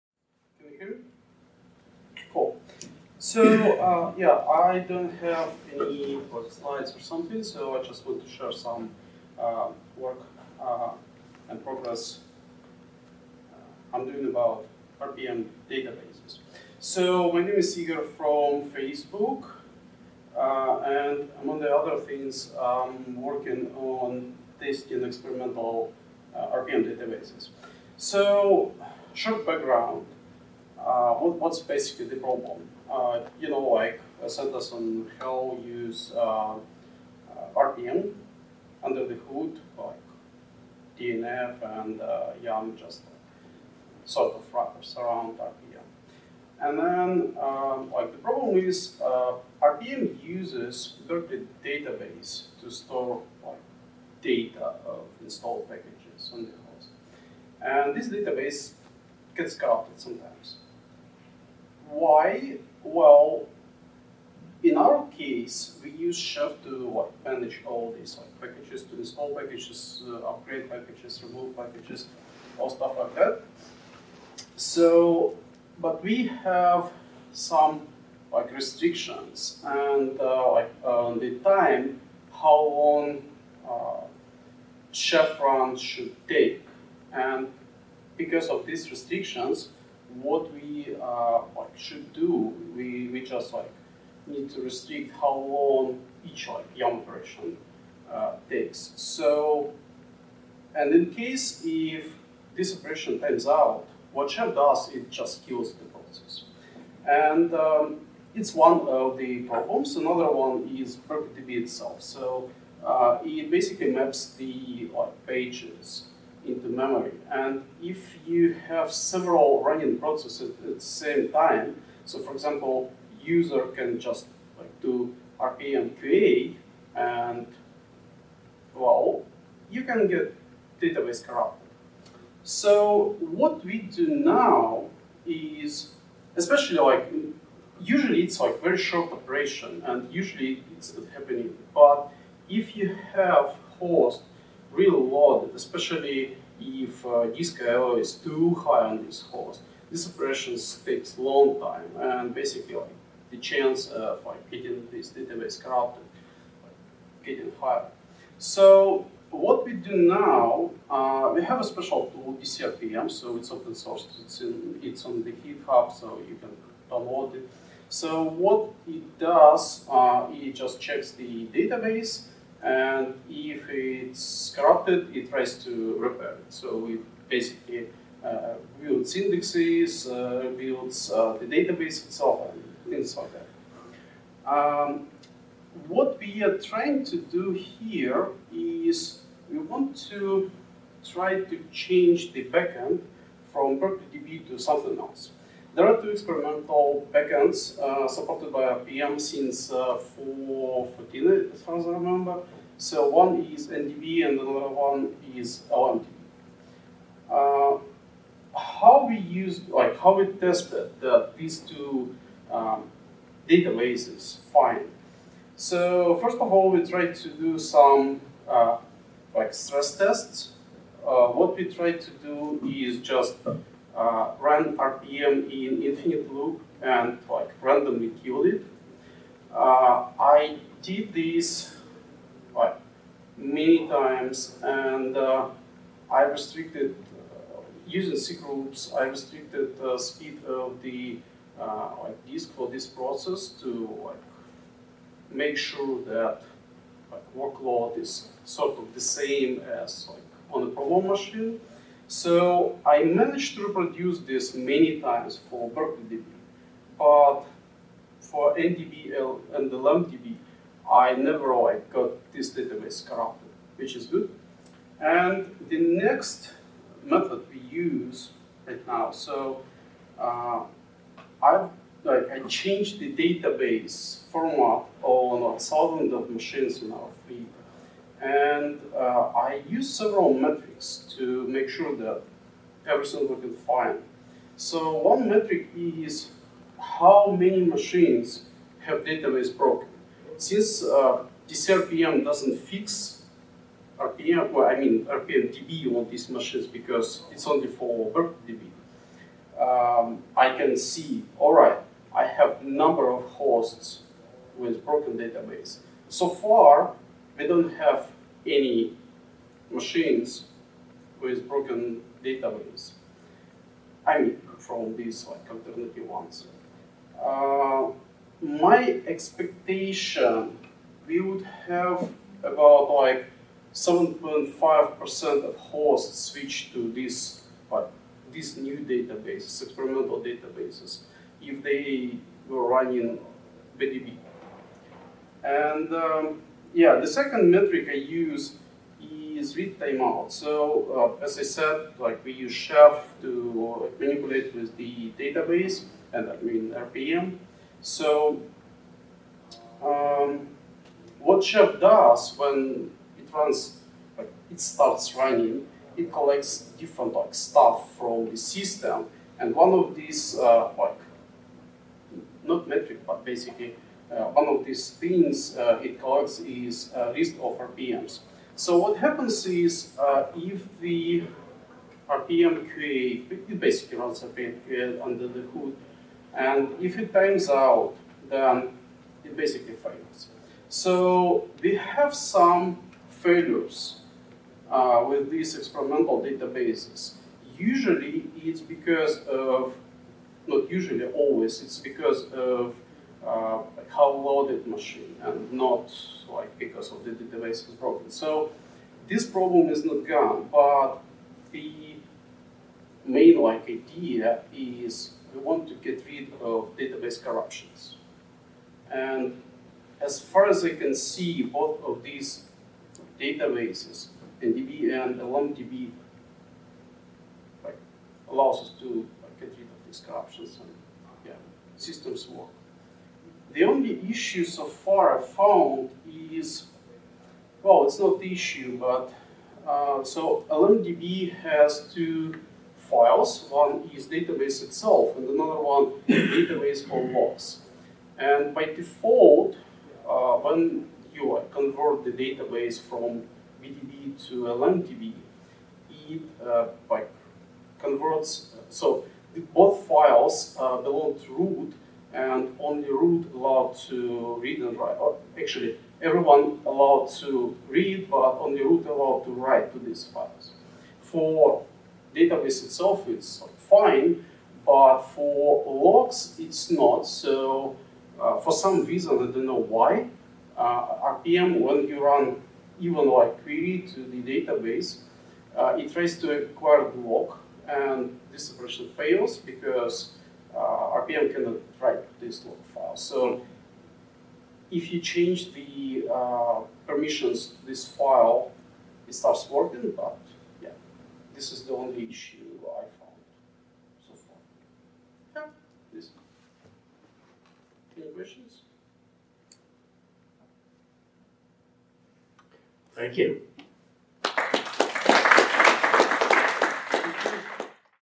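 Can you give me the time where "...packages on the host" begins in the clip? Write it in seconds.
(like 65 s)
55 s.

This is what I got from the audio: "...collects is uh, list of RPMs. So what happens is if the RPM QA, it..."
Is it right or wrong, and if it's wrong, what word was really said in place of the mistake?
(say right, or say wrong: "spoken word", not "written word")
right.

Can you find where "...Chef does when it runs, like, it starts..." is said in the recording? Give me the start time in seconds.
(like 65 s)
351 s.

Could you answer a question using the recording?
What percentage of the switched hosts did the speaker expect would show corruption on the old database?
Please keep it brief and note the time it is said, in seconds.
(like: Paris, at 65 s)
7.5%, at 323 s.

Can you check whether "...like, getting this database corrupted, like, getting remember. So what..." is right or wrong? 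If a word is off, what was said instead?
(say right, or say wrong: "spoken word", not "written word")
wrong: "higher", not "remember".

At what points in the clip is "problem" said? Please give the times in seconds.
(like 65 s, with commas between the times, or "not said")
32 s, 48 s, 109 s, 250 s, 399 s.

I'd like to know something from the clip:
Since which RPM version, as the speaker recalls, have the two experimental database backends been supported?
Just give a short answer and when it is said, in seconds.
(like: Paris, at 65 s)
4.14, at 200 s.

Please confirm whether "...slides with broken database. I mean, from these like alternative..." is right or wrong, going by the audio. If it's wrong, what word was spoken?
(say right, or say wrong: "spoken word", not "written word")
wrong: "machines", not "slides".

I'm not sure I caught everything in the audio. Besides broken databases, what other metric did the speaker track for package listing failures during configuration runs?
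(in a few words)
read timeout.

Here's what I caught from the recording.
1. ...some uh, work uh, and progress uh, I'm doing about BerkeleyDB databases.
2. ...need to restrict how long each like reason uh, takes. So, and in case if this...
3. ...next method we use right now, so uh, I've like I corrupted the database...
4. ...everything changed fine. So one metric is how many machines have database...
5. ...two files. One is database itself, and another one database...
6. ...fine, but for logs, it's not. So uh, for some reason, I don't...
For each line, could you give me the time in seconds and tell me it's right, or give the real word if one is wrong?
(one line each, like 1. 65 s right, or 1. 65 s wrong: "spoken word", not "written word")
1. 8 s wrong: "RPM", not "BerkeleyDB"
2. 94 s wrong: "operation", not "reason"
3. 265 s wrong: "changed", not "corrupted"
4. 282 s wrong: "looked", not "changed"
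5. 431 s right
6. 463 s right.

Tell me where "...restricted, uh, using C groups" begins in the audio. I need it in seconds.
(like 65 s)
236 s.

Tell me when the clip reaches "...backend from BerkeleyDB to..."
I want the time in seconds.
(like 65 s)
192 s.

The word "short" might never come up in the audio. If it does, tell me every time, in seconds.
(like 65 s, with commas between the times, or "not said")
29 s, 138 s.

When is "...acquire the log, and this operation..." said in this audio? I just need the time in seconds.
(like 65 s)
476 s.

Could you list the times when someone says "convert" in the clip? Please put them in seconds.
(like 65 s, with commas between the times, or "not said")
441 s, 447 s.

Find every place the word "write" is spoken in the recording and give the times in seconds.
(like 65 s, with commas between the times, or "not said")
454 s, 459 s, 481 s.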